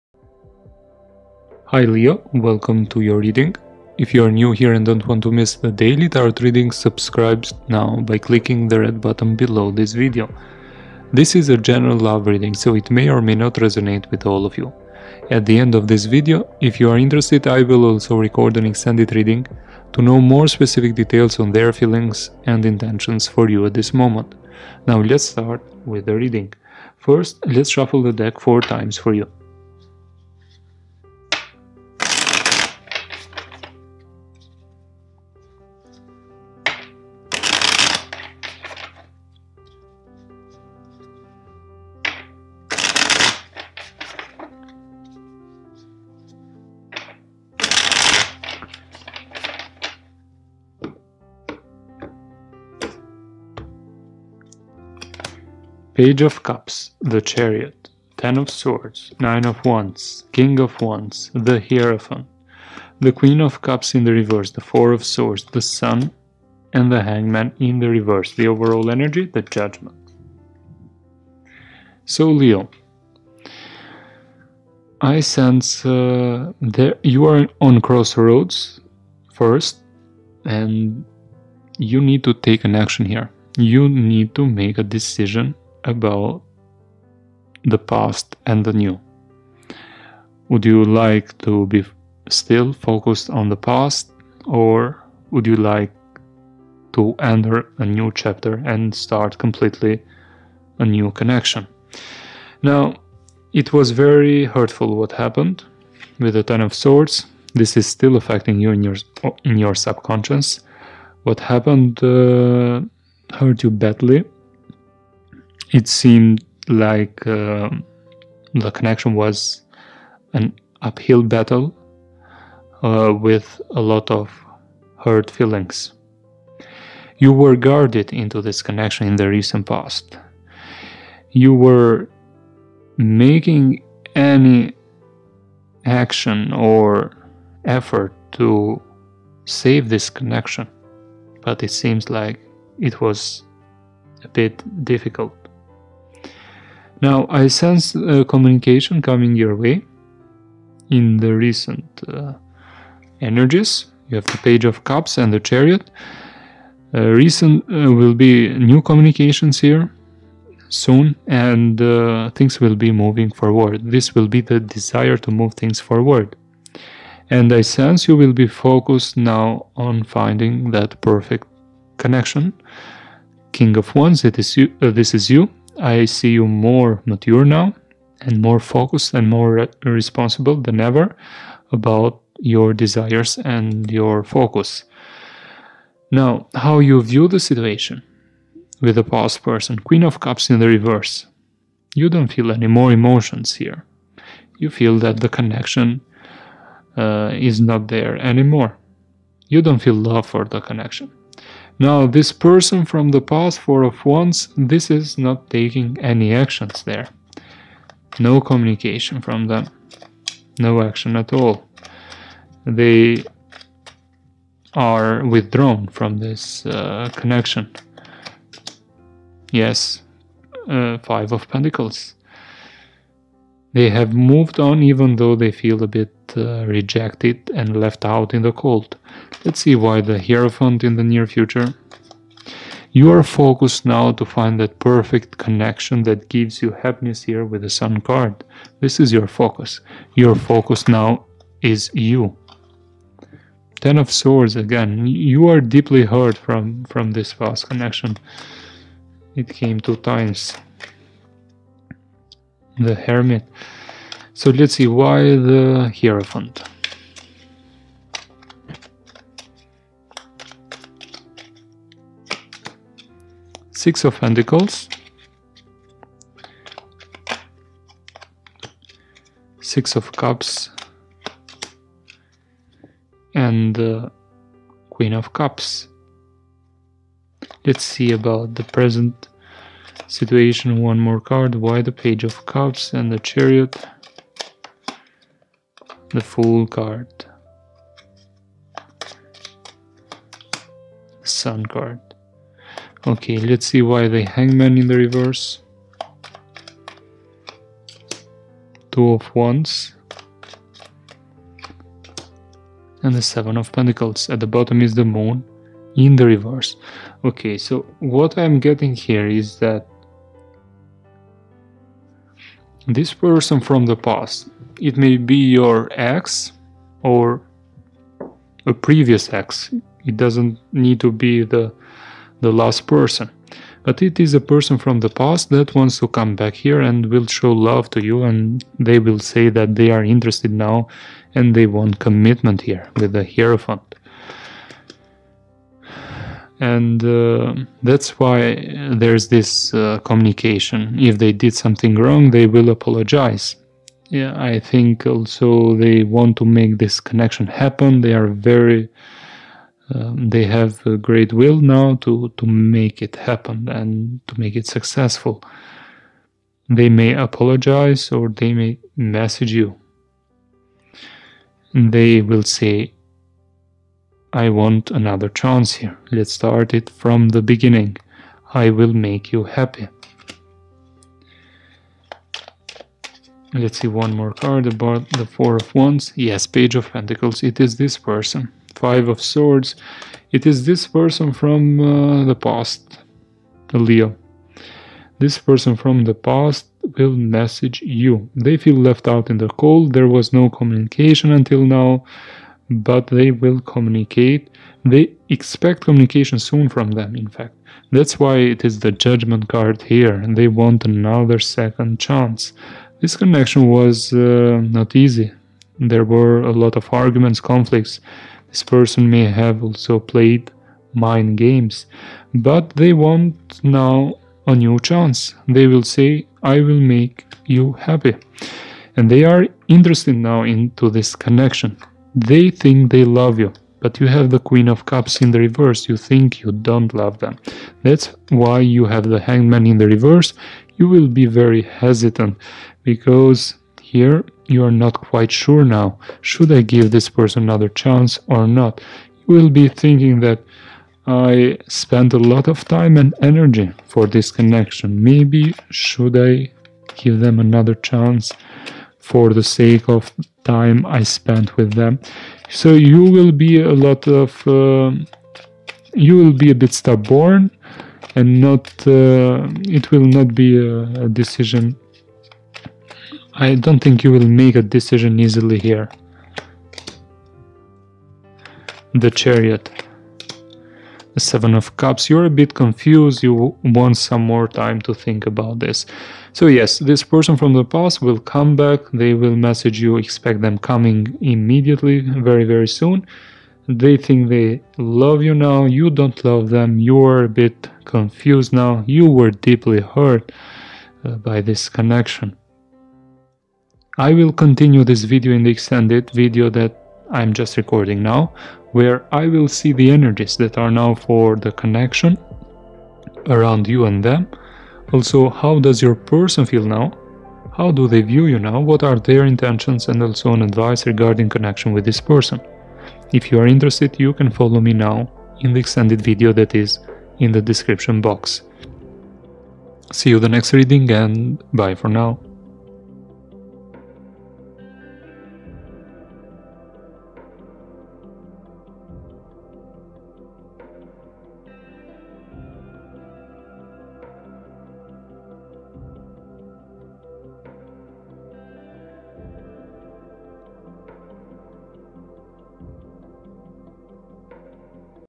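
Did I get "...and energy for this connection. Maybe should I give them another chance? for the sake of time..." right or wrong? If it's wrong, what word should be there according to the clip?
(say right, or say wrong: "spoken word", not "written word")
right.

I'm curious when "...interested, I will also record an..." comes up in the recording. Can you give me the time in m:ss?
0:16.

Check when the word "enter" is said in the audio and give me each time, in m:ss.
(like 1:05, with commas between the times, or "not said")
1:37.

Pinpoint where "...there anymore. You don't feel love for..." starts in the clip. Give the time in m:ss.
3:17.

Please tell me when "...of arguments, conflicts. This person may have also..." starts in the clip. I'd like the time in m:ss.
6:46.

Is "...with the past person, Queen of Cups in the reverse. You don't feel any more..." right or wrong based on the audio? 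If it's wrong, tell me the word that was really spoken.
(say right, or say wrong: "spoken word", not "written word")
right.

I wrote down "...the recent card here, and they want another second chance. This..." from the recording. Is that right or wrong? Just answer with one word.
wrong.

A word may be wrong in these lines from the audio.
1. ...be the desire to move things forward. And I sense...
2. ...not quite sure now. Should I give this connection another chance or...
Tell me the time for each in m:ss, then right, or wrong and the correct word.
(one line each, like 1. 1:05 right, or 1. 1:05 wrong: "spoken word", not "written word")
1. 2:44 right
2. 7:14 wrong: "person", not "connection".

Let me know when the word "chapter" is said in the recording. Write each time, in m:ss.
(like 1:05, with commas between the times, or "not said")
1:38.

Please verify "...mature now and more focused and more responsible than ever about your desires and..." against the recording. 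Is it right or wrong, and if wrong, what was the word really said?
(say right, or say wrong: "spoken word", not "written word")
right.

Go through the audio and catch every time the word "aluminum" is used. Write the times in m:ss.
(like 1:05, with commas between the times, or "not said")
not said.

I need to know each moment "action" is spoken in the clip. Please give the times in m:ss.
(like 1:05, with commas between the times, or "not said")
1:22, 2:15, 3:26, 3:30.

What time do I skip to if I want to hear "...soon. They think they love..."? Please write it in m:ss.
8:02.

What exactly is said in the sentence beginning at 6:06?
Let's start it from the beginning.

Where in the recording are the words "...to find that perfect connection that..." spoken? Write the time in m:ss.
3:54.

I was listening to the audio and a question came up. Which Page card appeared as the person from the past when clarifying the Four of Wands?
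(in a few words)
Page of Pentacles.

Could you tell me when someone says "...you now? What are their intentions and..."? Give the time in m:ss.
8:28.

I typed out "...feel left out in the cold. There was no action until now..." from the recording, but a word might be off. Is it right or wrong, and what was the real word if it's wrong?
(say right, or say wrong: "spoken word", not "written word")
wrong: "communication", not "action".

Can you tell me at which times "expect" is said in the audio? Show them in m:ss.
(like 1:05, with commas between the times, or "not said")
6:35, 7:59.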